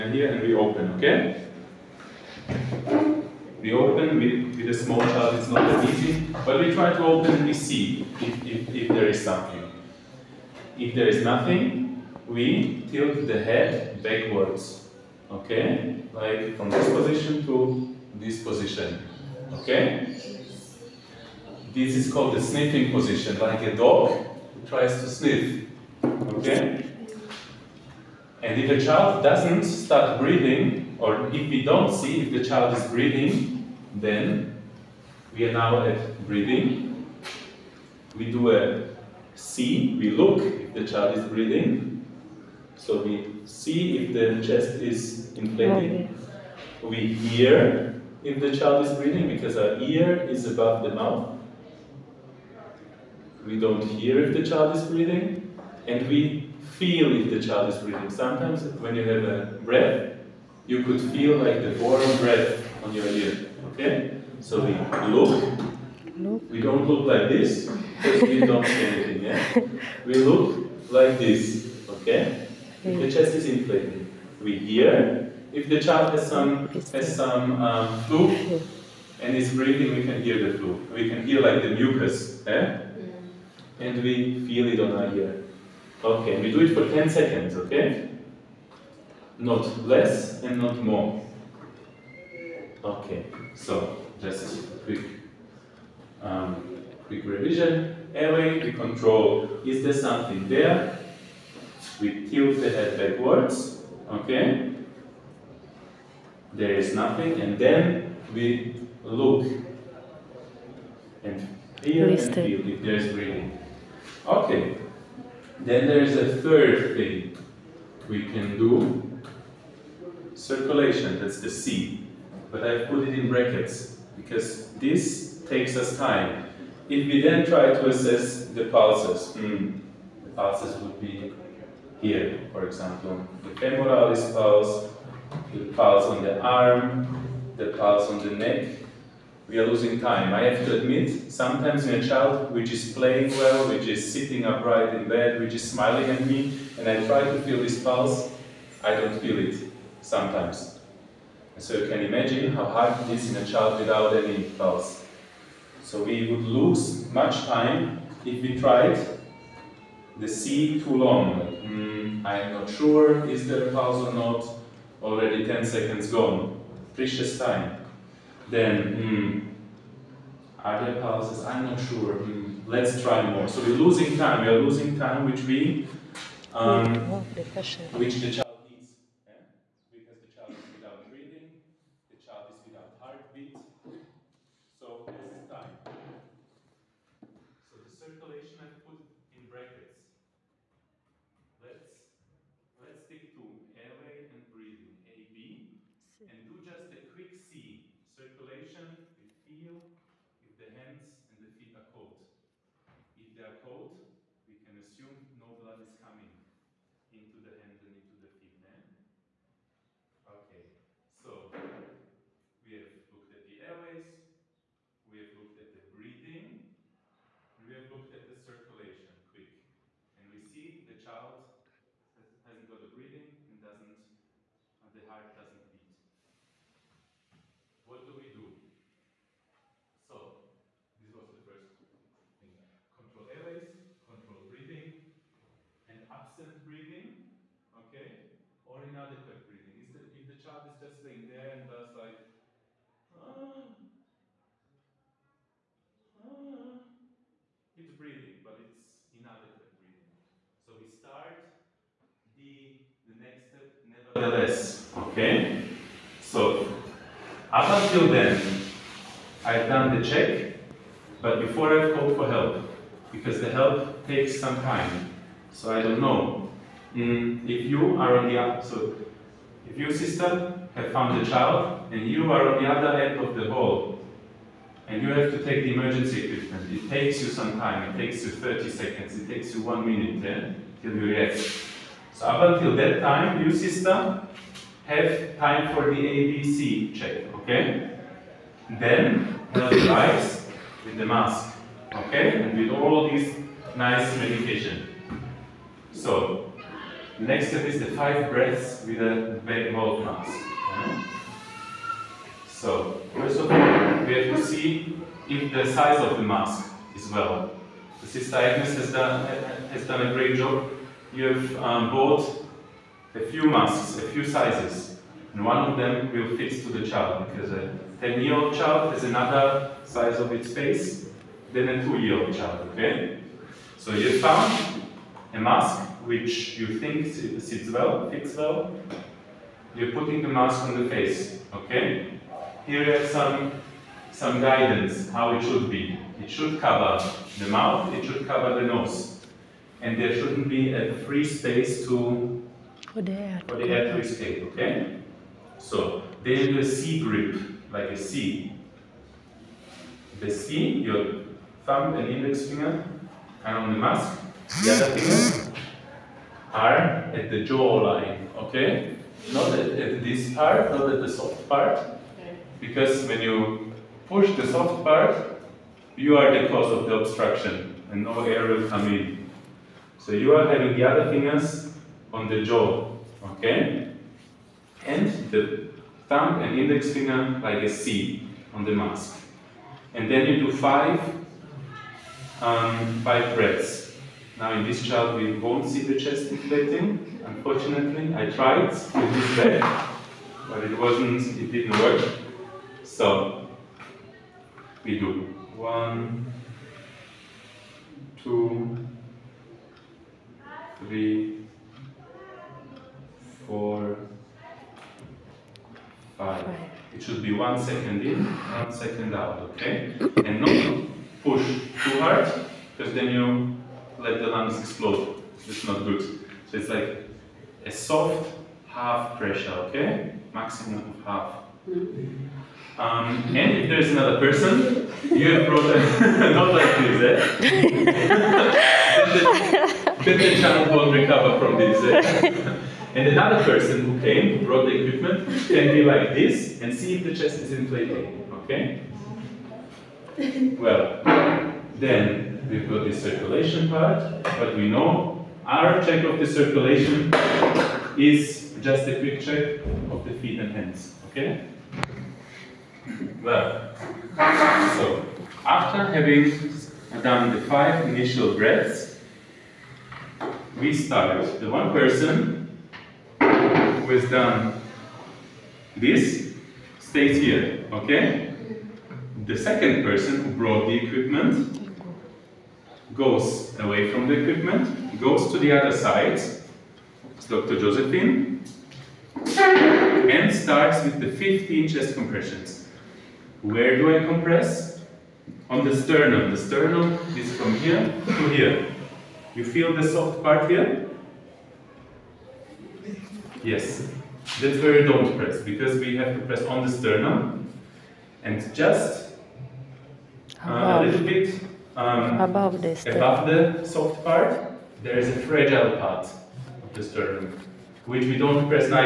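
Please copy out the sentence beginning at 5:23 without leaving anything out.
So you found a mask which you think sits well, fits well.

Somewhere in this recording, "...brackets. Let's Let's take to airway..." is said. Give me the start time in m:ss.
3:09.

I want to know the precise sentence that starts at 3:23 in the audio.
If they are cold, we can assume no blood is coming into the hand and into the feet.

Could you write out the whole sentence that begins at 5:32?
Here you have some, some guidance how it should be.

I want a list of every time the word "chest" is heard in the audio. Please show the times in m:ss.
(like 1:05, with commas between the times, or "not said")
0:44, 1:13, 6:25, 7:17, 8:01.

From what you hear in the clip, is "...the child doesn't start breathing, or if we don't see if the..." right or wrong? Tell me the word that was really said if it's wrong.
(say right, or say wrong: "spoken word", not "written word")
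right.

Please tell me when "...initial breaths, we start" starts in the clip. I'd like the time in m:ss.
7:37.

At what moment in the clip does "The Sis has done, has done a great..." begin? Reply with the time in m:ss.
5:08.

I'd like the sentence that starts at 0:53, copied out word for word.
We don't hear if the child is breathing.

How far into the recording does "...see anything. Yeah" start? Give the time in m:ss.
1:08.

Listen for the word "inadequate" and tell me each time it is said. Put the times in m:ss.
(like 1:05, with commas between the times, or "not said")
3:58, 4:09.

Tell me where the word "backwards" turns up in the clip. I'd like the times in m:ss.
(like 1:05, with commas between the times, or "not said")
0:14, 1:42.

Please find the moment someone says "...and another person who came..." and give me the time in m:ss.
7:12.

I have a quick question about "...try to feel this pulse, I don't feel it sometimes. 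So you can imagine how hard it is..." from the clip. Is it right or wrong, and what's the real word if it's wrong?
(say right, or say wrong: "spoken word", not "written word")
right.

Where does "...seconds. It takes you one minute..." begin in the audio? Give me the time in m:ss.
4:38.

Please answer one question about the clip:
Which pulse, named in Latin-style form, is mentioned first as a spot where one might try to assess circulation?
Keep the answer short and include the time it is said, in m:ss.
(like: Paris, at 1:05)
femoralis, at 2:13.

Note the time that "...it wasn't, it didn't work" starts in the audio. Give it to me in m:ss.
6:30.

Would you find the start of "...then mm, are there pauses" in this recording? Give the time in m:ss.
2:48.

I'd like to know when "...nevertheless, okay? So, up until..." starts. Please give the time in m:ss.
4:13.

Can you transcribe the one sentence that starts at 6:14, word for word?
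And the thumb and index finger like a C on the mask.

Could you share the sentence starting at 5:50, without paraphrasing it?
The C, your thumb and index finger are on the mask, the other fingers are at the jawline, okay?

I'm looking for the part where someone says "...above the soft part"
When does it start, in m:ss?
8:22.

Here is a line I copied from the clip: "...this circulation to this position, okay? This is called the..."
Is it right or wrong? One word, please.
wrong.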